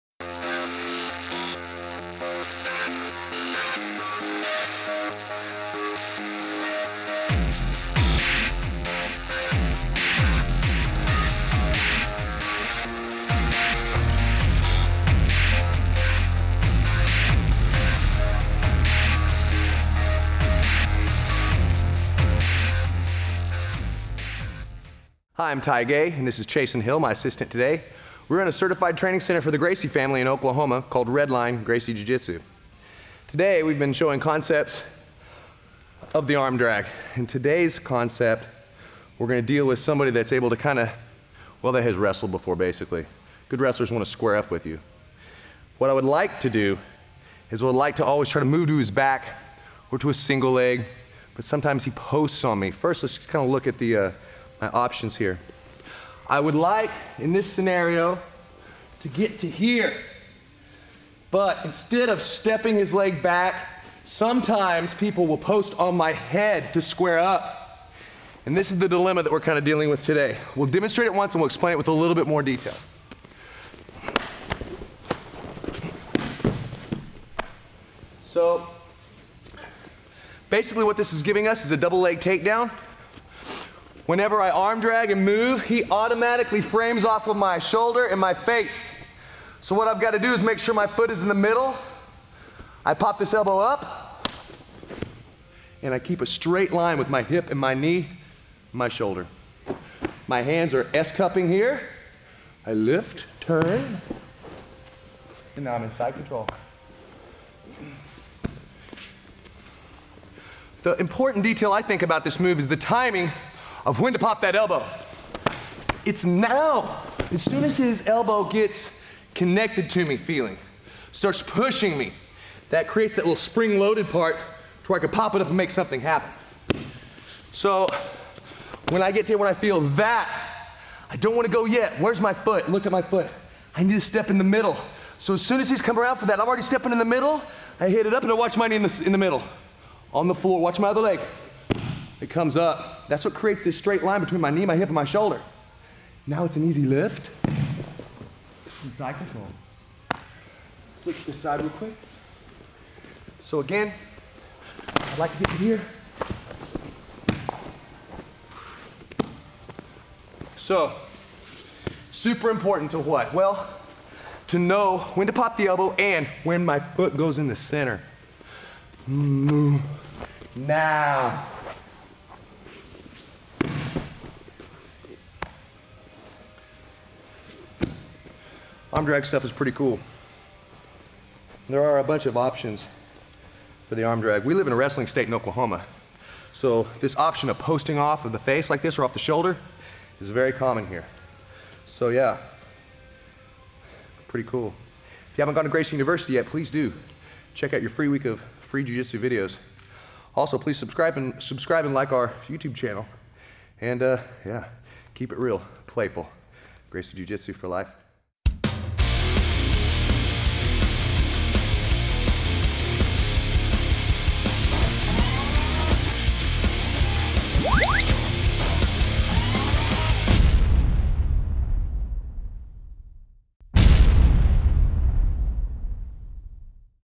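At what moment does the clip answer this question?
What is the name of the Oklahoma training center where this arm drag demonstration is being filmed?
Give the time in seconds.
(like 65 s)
31 s.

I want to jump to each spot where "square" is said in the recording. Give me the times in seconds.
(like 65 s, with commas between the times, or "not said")
44 s, 66 s.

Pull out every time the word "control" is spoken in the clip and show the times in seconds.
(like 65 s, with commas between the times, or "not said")
106 s, 149 s.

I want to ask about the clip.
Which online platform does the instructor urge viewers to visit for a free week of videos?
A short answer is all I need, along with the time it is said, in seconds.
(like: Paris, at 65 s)
Gracie University, at 195 s.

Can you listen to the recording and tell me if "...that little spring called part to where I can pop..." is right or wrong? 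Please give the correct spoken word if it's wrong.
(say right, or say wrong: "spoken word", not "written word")
wrong: "loaded", not "called".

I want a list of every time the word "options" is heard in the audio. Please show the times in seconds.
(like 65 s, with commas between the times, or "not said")
54 s, 182 s, 187 s.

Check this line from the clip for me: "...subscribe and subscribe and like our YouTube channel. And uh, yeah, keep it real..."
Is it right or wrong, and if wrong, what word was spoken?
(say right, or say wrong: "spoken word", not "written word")
right.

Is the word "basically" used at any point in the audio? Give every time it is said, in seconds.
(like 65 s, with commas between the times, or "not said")
42 s, 80 s.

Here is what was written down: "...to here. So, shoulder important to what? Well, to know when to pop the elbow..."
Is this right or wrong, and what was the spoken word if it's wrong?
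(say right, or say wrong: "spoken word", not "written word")
wrong: "super", not "shoulder".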